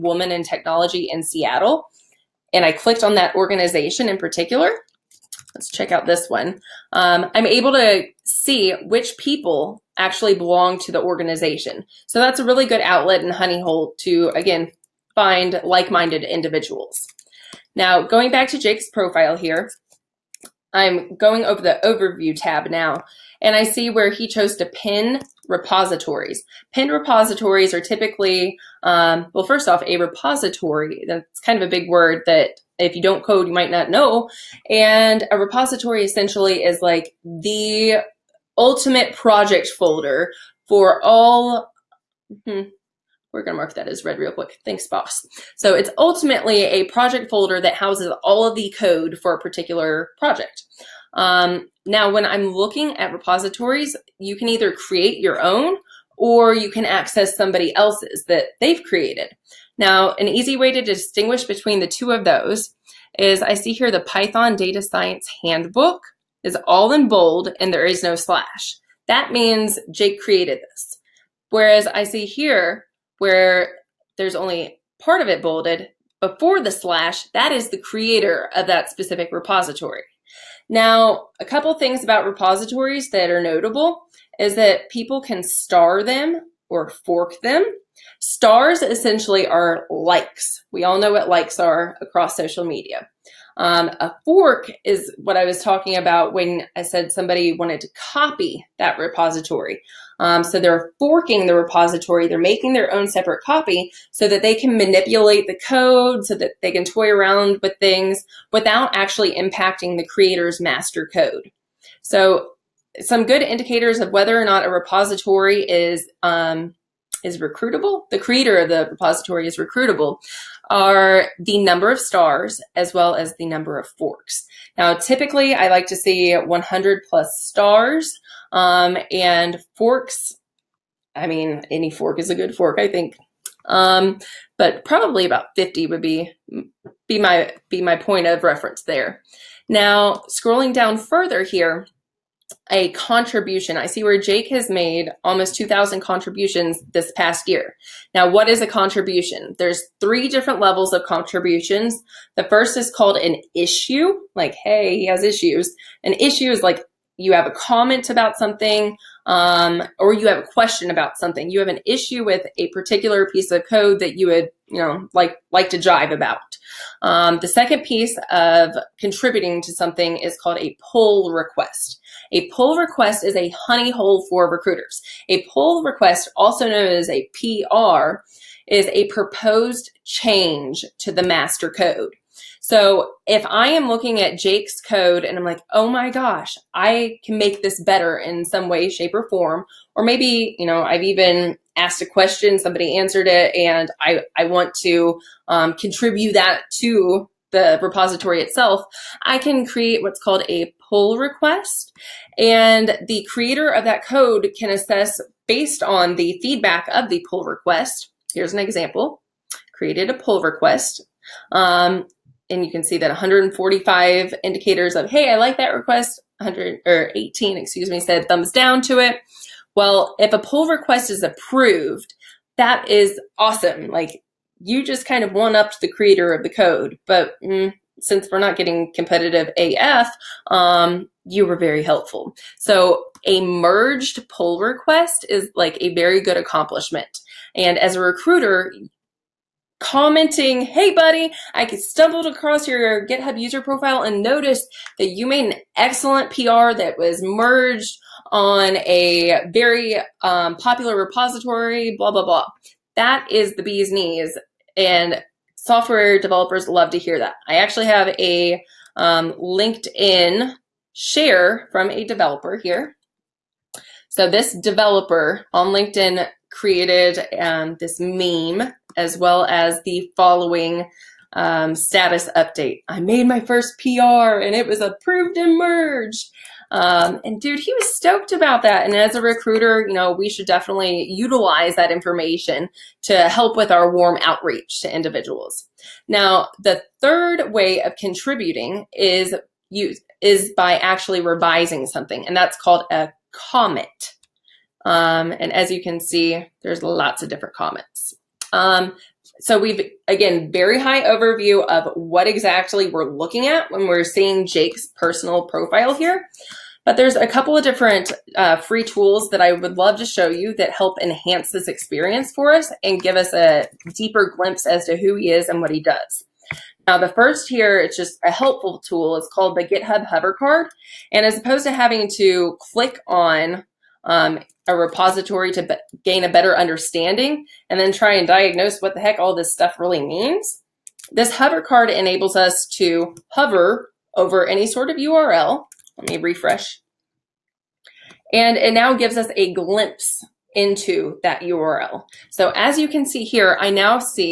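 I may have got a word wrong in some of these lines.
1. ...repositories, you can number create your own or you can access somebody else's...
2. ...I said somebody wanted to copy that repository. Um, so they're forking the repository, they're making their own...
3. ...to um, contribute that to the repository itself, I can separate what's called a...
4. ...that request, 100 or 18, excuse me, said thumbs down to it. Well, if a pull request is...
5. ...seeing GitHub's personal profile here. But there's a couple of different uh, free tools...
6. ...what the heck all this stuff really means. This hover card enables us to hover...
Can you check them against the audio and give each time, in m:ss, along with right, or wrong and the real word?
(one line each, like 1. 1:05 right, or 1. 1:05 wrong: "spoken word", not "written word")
1. 0:53 wrong: "either", not "number"
2. 1:36 right
3. 3:14 wrong: "create", not "separate"
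4. 3:35 right
5. 5:04 wrong: "Jake", not "GitHub"
6. 5:28 right.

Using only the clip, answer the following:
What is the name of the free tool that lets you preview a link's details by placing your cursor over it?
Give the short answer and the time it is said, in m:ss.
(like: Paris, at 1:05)
GitHub Hover Card, at 5:19.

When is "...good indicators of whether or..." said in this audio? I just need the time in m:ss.
1:53.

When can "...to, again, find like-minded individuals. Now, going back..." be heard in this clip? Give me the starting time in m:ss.
0:13.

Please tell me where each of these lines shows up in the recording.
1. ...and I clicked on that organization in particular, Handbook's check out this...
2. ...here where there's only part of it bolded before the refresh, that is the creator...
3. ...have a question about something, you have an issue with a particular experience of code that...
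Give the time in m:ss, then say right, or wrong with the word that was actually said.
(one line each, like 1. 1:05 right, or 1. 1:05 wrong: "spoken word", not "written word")
1. 0:02 wrong: "Let", not "Handbook"
2. 1:12 wrong: "slash", not "refresh"
3. 2:40 wrong: "piece", not "experience".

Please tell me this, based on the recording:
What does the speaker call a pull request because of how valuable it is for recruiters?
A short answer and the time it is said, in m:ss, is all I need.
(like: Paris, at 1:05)
A honey hole, at 2:53.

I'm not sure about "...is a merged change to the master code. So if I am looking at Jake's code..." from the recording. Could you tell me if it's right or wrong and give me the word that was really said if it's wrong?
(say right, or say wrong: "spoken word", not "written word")
wrong: "proposed", not "merged".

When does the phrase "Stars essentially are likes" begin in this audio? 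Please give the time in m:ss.
1:28.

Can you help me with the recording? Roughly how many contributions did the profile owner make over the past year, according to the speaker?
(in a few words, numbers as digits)
2,000.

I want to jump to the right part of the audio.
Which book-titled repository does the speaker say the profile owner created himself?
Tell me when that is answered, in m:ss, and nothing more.
1:03.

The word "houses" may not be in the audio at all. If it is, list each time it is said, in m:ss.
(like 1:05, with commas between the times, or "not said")
0:47.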